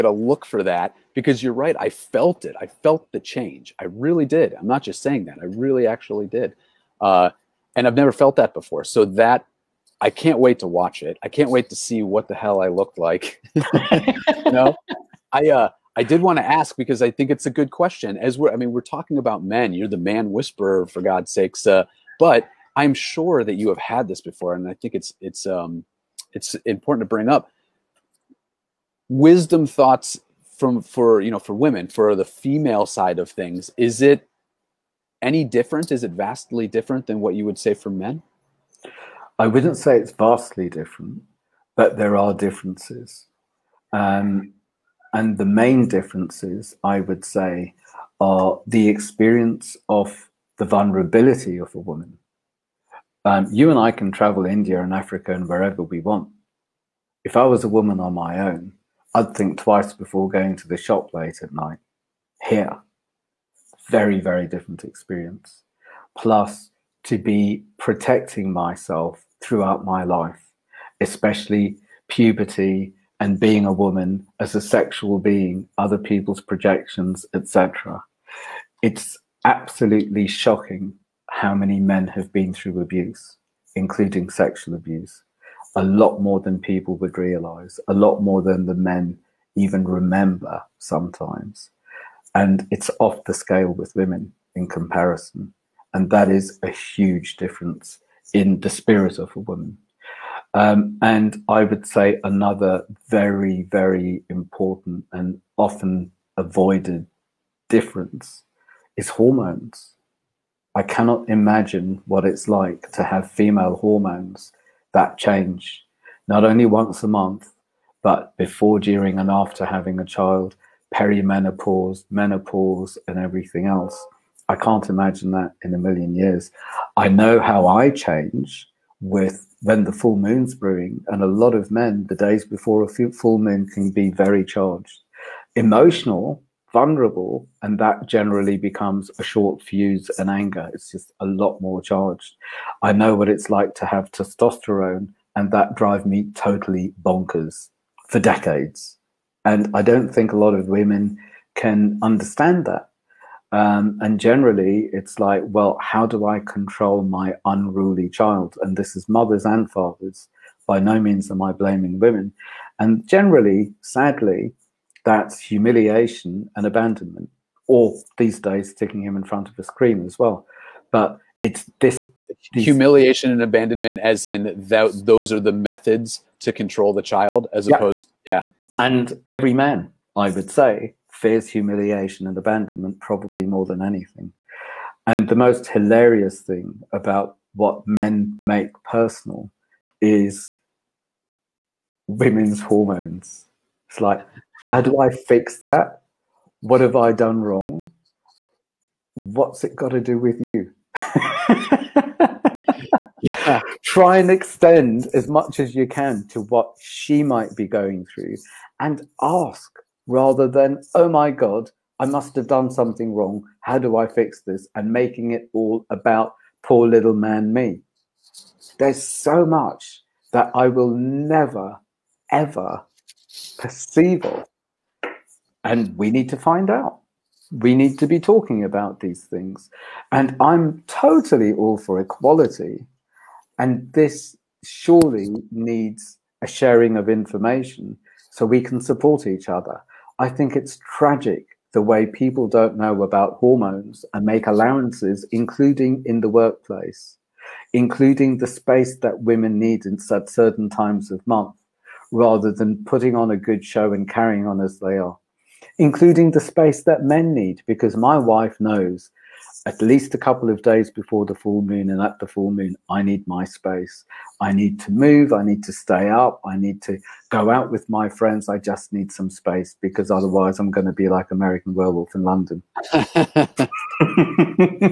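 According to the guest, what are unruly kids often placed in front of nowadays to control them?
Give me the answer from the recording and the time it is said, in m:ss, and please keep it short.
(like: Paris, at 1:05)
A screen, at 2:49.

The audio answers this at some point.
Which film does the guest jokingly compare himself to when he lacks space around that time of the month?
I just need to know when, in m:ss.
4:31.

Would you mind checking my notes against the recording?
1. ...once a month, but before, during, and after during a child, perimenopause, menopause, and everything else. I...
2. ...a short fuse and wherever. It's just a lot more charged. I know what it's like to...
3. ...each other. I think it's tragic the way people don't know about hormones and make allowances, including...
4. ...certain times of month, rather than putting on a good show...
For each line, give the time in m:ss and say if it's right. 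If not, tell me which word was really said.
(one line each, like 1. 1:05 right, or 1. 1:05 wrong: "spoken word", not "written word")
1. 1:56 wrong: "having", not "during"
2. 2:19 wrong: "anger", not "wherever"
3. 3:59 right
4. 4:10 right.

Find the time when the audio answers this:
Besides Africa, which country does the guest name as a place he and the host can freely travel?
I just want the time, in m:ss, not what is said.
0:54.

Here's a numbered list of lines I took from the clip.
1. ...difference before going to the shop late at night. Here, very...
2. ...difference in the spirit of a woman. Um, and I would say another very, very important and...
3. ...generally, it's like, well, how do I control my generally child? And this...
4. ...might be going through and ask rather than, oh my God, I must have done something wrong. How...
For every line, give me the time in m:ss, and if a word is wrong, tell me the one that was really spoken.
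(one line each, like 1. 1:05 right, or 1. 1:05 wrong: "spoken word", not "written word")
1. 0:59 wrong: "twice", not "difference"
2. 1:37 right
3. 2:34 wrong: "unruly", not "generally"
4. 3:27 right.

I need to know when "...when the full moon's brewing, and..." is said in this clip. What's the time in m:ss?
2:09.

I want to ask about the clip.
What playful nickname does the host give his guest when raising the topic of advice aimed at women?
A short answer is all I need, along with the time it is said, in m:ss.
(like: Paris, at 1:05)
The man whisperer, at 0:19.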